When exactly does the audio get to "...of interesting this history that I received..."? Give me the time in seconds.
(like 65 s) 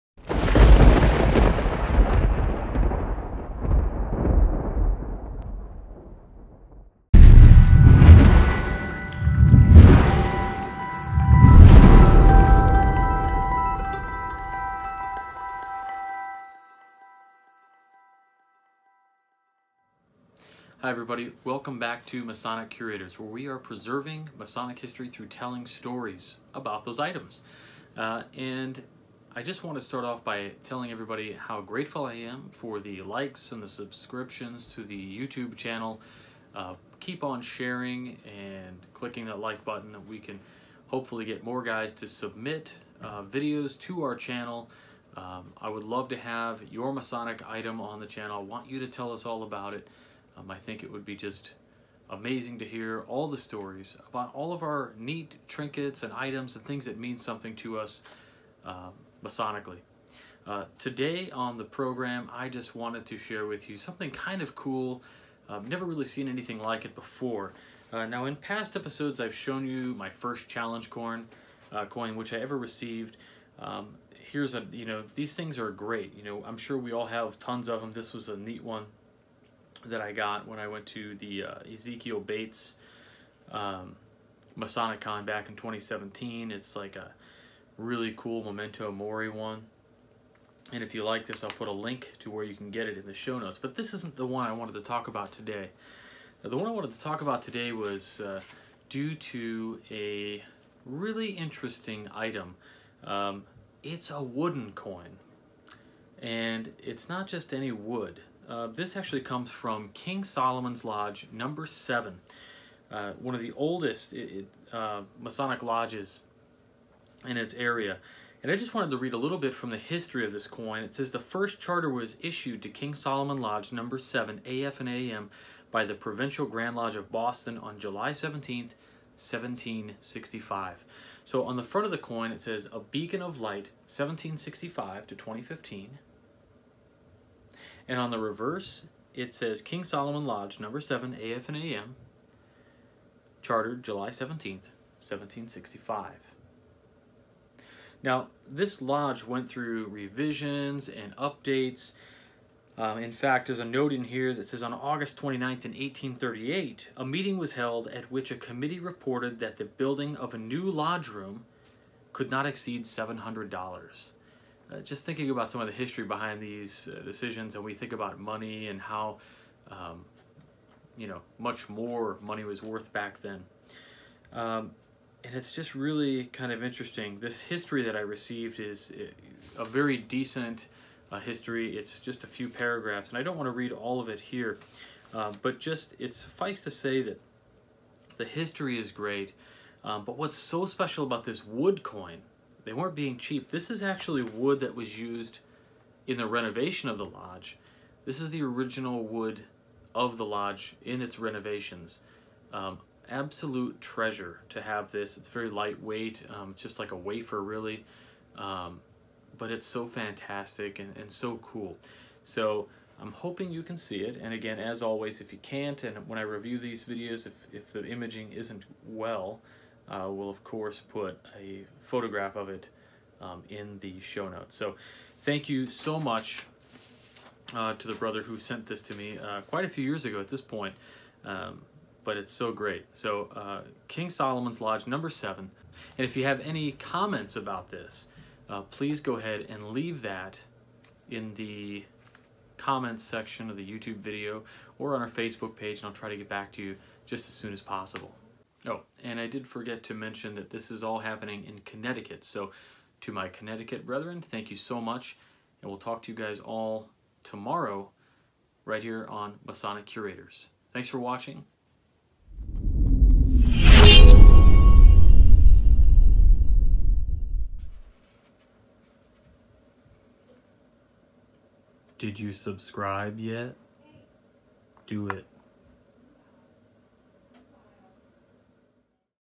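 176 s.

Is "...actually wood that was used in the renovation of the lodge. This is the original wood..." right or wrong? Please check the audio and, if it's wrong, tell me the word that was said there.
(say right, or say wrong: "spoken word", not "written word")
right.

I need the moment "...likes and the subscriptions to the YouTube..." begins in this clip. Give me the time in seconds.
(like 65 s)
33 s.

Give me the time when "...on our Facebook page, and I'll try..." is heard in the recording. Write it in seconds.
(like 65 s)
244 s.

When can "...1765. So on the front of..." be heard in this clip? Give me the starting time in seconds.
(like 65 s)
129 s.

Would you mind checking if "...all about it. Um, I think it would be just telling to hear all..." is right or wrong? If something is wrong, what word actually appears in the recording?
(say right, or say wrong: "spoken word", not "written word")
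wrong: "amazing", not "telling".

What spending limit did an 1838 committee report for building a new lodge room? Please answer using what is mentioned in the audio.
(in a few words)
$700.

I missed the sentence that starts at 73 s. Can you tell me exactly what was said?
Um, here's a, you know, these things are great.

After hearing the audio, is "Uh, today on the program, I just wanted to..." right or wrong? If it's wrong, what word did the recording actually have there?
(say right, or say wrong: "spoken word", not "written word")
right.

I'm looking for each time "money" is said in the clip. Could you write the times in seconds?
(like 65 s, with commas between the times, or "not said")
168 s, 172 s.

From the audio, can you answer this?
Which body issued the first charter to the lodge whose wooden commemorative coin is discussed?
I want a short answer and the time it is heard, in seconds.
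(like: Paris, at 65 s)
Provincial Grand Lodge of Boston, at 125 s.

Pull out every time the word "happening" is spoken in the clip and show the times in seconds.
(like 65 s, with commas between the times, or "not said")
250 s.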